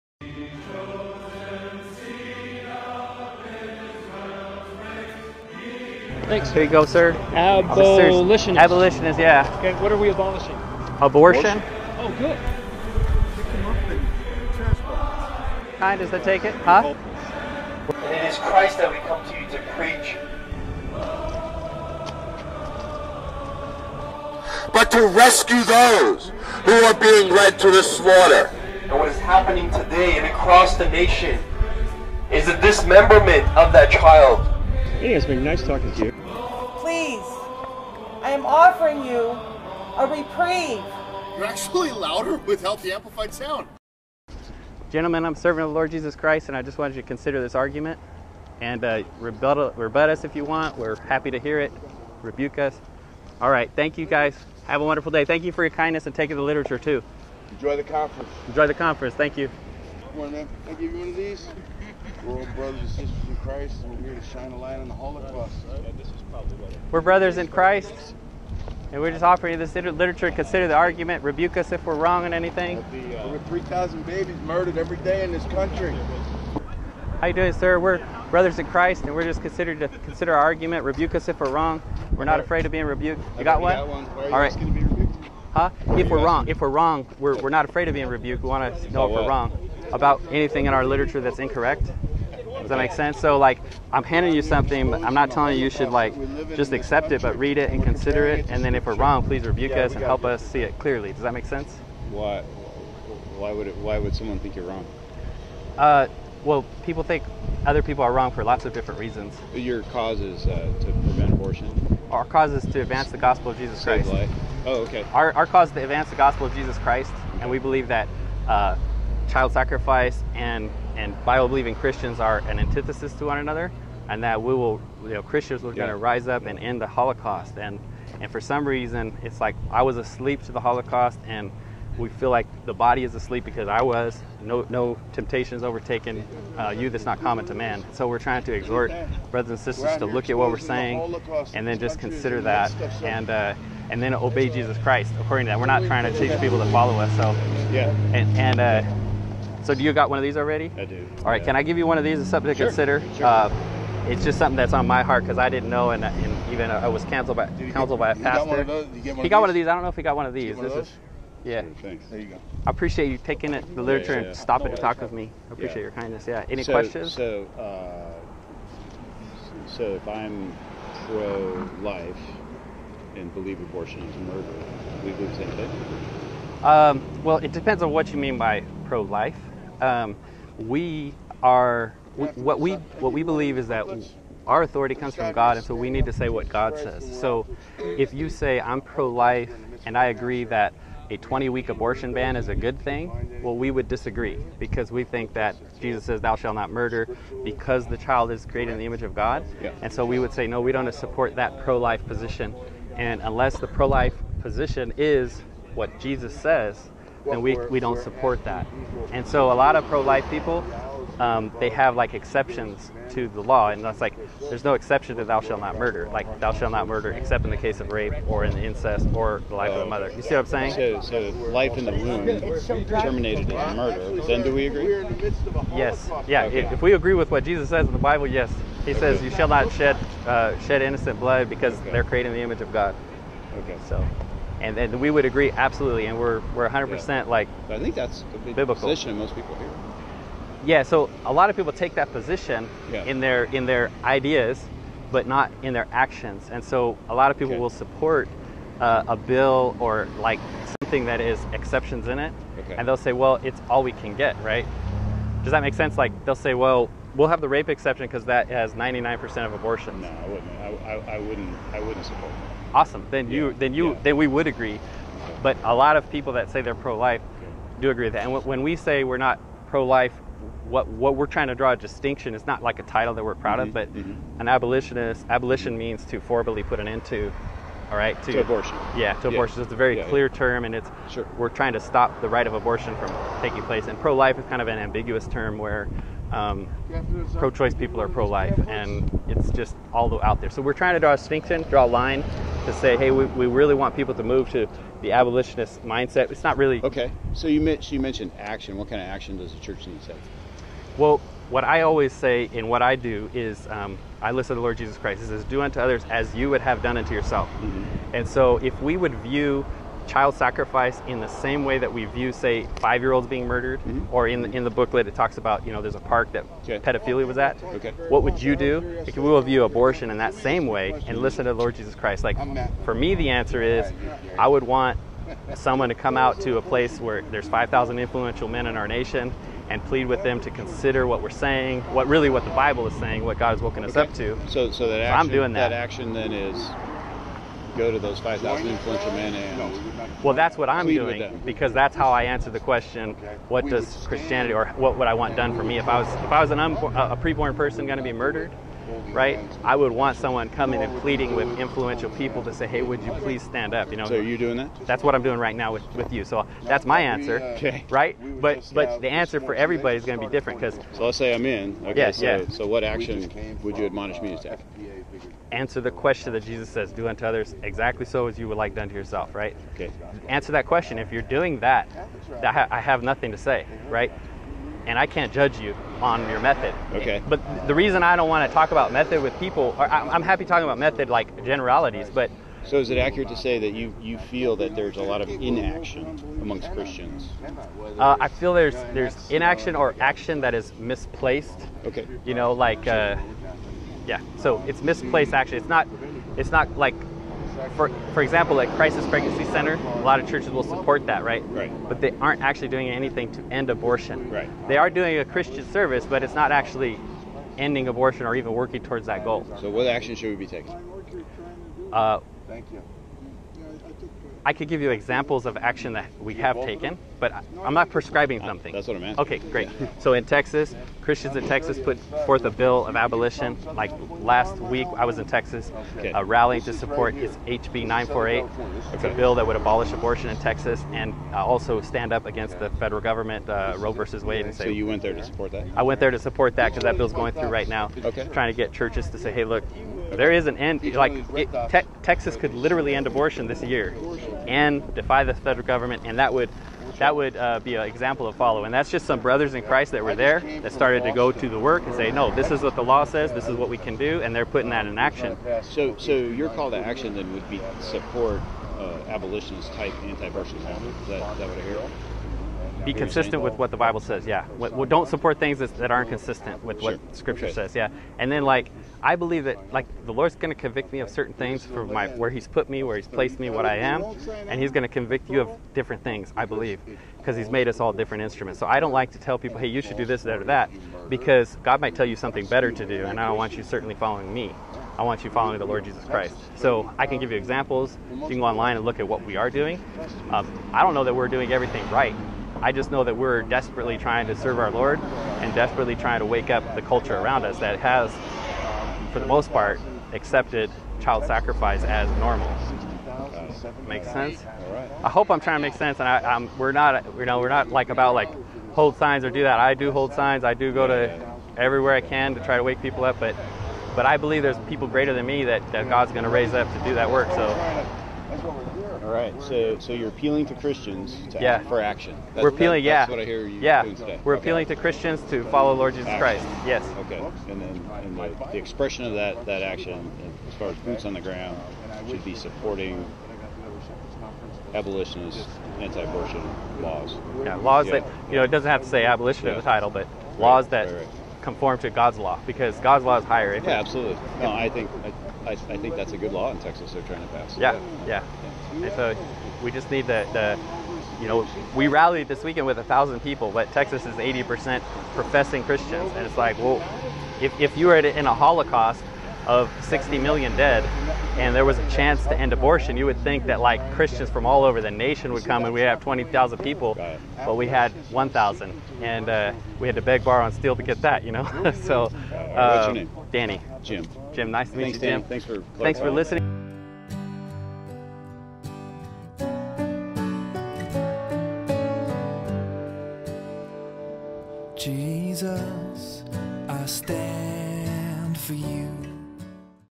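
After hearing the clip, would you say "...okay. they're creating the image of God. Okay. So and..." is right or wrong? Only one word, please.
right.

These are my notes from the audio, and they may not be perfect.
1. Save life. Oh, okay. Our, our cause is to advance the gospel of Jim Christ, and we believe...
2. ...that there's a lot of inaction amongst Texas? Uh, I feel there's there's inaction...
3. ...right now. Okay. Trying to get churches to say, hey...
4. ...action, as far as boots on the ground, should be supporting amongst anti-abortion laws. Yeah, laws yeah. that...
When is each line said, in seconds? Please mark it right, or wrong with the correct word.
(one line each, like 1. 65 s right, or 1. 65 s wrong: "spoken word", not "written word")
1. 114 s wrong: "Jesus", not "Jim"
2. 384 s wrong: "Christians", not "Texas"
3. 437 s right
4. 529 s wrong: "abolitionist", not "amongst".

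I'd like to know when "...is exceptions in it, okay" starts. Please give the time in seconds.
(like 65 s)
251 s.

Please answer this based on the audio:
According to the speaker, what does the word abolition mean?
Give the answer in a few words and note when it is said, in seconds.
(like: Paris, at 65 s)
forcibly put an end to, at 276 s.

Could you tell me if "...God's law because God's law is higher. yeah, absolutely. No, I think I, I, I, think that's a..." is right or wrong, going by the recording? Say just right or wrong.
right.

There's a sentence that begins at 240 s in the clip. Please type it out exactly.
Yeah, so a lot of people take that position yeah.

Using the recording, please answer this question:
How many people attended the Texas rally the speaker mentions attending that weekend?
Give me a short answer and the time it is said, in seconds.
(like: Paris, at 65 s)
1,000, at 552 s.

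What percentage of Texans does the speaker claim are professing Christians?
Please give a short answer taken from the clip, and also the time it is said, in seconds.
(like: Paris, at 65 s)
80%, at 554 s.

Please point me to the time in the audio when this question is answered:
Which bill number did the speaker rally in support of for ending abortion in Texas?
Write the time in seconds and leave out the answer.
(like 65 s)
427 s.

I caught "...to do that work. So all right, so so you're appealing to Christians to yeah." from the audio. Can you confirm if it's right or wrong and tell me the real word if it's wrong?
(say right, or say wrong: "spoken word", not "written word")
right.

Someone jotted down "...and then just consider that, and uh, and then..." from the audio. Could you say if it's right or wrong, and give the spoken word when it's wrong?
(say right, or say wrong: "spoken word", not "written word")
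right.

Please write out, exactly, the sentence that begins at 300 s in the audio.
Well, what I always say in what I do is um, I listen to the Lord Jesus Christ.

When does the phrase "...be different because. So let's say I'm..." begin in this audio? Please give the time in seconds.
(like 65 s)
360 s.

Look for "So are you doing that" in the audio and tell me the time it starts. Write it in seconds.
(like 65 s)
354 s.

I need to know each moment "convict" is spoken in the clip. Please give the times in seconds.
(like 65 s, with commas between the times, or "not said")
470 s, 474 s.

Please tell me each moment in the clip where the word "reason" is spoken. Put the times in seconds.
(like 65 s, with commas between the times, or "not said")
108 s, 128 s, 377 s.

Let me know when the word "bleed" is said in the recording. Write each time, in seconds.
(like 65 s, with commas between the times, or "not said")
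not said.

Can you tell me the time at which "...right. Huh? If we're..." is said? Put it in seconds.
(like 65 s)
84 s.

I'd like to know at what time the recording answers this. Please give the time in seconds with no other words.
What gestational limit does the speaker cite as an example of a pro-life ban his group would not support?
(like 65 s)
191 s.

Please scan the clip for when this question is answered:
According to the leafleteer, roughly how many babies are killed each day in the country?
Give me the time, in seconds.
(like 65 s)
73 s.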